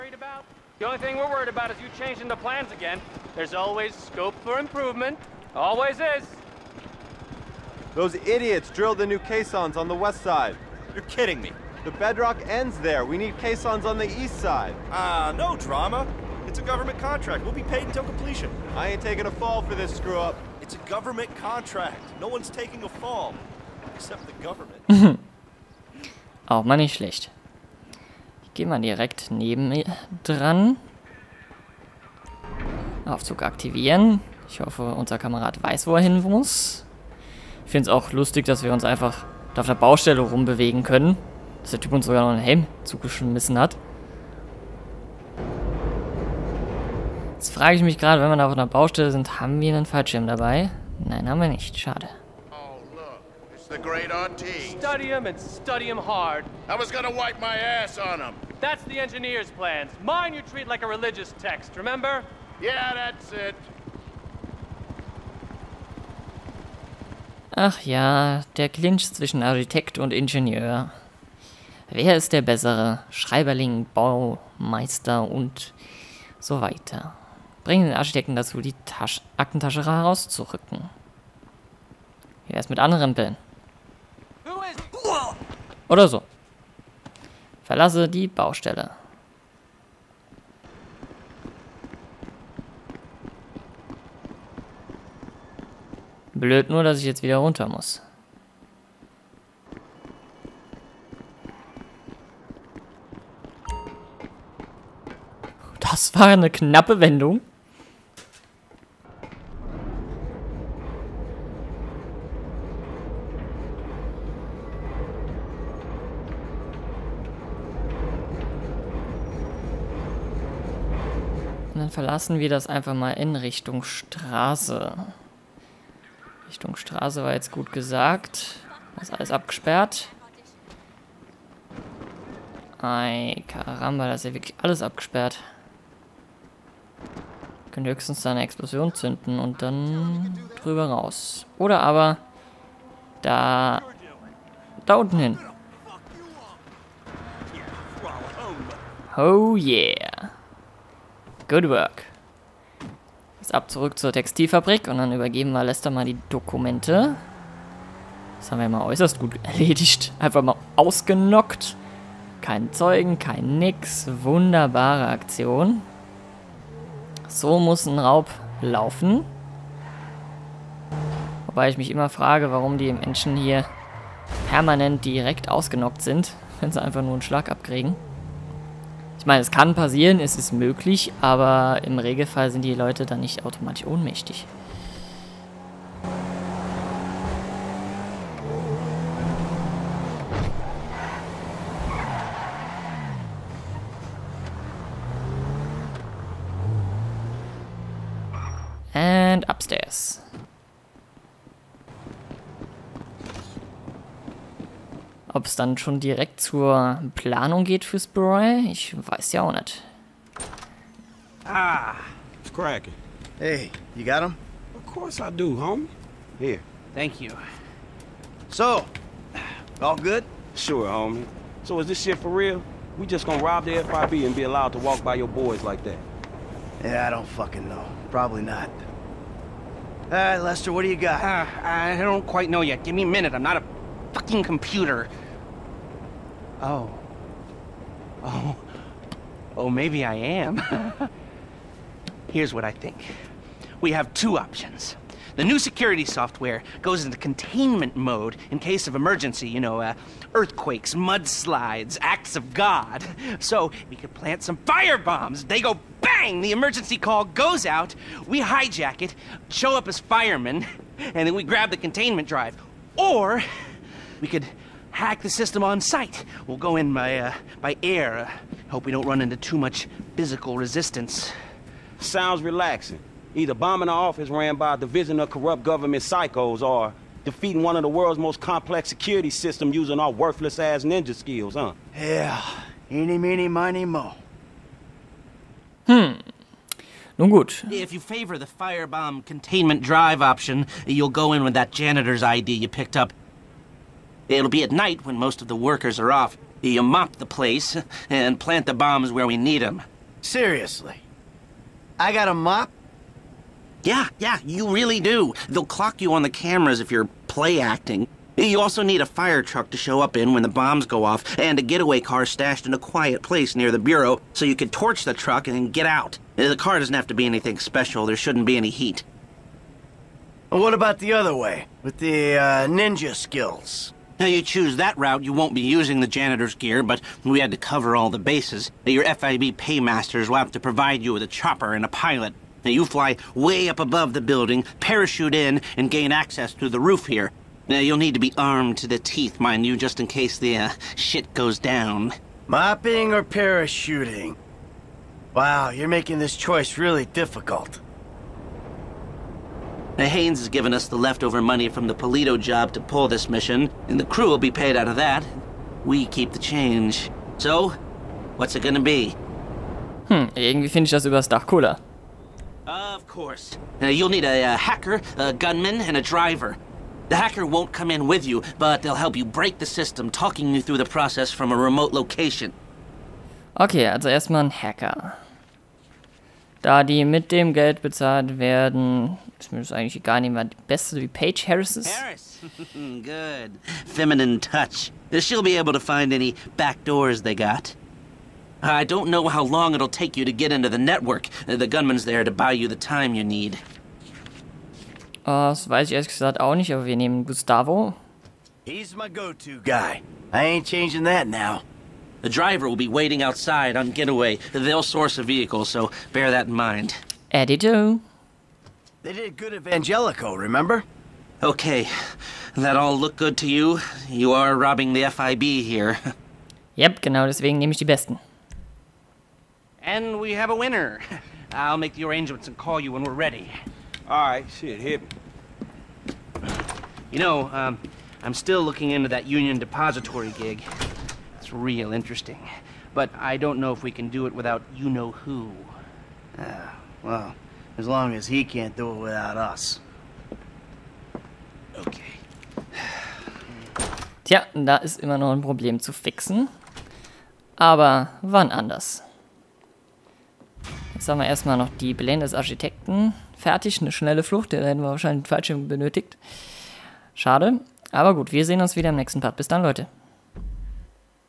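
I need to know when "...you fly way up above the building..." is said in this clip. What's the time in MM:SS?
05:32.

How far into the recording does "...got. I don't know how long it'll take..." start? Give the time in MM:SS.
06:27.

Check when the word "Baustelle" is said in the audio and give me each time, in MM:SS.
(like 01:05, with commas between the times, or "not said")
00:39, 00:48, 01:28.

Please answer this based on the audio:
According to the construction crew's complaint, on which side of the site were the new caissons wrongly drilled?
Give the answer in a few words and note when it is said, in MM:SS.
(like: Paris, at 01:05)
West side, at 00:09.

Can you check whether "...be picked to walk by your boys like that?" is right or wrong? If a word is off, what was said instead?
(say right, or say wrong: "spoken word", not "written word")
wrong: "allowed", not "picked".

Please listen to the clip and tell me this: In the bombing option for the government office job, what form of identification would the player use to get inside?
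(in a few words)
Janitor's ID.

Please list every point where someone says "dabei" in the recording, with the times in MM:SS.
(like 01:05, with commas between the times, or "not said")
00:50.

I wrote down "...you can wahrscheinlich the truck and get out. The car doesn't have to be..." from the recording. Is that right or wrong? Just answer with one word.
wrong.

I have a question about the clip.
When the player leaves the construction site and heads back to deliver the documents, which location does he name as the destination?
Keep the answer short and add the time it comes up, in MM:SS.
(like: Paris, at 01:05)
Textilfabrik, at 02:34.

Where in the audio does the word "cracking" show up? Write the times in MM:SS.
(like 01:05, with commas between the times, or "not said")
03:32.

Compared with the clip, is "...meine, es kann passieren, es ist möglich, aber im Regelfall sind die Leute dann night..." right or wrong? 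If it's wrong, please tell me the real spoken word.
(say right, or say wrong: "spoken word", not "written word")
wrong: "nicht", not "night".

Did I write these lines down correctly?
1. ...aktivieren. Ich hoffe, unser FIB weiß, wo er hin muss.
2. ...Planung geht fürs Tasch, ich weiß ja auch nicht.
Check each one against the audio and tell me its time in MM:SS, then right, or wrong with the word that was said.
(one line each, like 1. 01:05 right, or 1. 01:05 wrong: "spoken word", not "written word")
1. 00:33 wrong: "Kamerad", not "FIB"
2. 03:27 wrong: "Beret", not "Tasch".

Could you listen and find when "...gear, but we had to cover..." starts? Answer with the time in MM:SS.
05:26.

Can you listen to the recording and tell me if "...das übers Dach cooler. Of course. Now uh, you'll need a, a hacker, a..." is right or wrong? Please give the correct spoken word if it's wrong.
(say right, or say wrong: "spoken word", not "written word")
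right.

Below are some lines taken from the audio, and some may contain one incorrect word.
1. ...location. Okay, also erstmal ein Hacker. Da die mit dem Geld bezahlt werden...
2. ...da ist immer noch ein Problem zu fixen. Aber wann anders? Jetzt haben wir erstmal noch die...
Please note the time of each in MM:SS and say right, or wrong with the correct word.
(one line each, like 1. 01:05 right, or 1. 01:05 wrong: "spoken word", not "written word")
1. 06:11 right
2. 07:24 right.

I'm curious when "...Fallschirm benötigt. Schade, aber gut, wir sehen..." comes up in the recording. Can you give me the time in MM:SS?
07:35.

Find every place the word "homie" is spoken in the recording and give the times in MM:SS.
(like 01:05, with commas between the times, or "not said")
03:35, 03:40.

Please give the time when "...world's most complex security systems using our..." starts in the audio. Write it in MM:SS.
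04:37.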